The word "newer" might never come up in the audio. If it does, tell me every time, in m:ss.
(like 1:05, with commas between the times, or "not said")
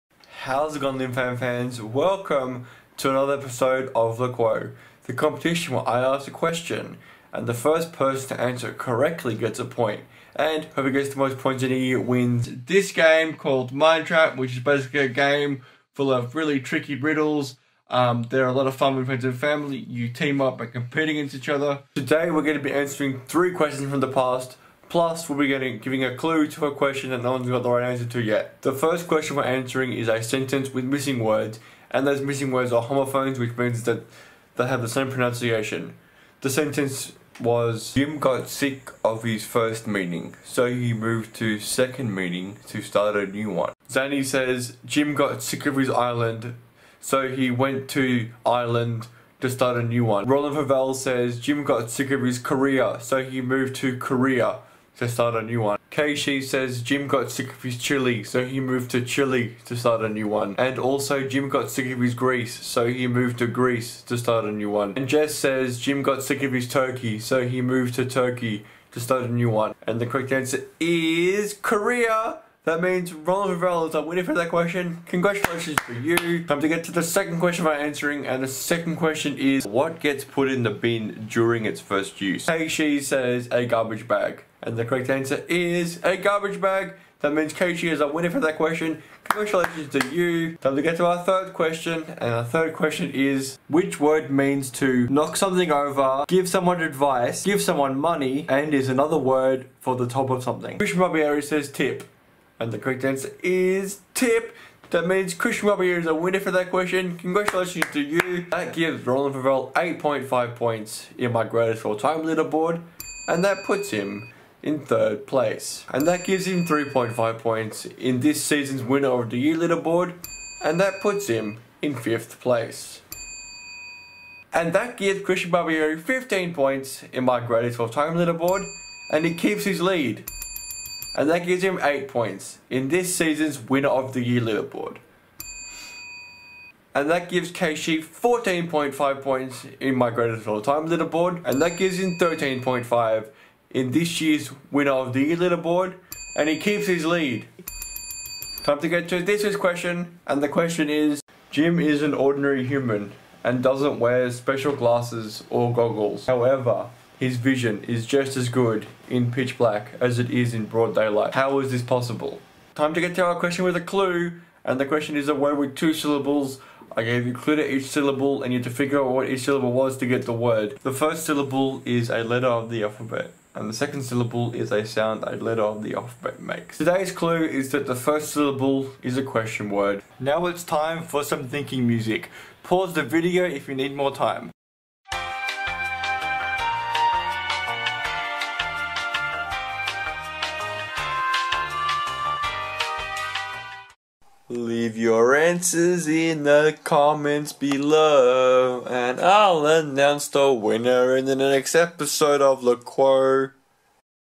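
not said.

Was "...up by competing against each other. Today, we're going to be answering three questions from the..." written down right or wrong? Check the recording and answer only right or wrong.
right.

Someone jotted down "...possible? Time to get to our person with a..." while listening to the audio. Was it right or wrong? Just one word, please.
wrong.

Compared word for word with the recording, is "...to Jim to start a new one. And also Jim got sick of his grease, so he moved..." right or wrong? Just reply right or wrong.
wrong.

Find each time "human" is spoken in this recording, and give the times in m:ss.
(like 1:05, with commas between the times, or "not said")
2:32.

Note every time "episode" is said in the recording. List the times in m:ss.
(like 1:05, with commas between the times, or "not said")
0:03, 3:21.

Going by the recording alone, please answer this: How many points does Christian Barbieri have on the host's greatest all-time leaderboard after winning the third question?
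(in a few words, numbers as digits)
15.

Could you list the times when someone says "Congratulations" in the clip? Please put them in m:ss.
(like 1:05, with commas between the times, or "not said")
1:15, 1:29, 1:47.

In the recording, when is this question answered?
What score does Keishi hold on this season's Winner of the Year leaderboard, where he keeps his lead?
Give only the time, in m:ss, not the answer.
2:22.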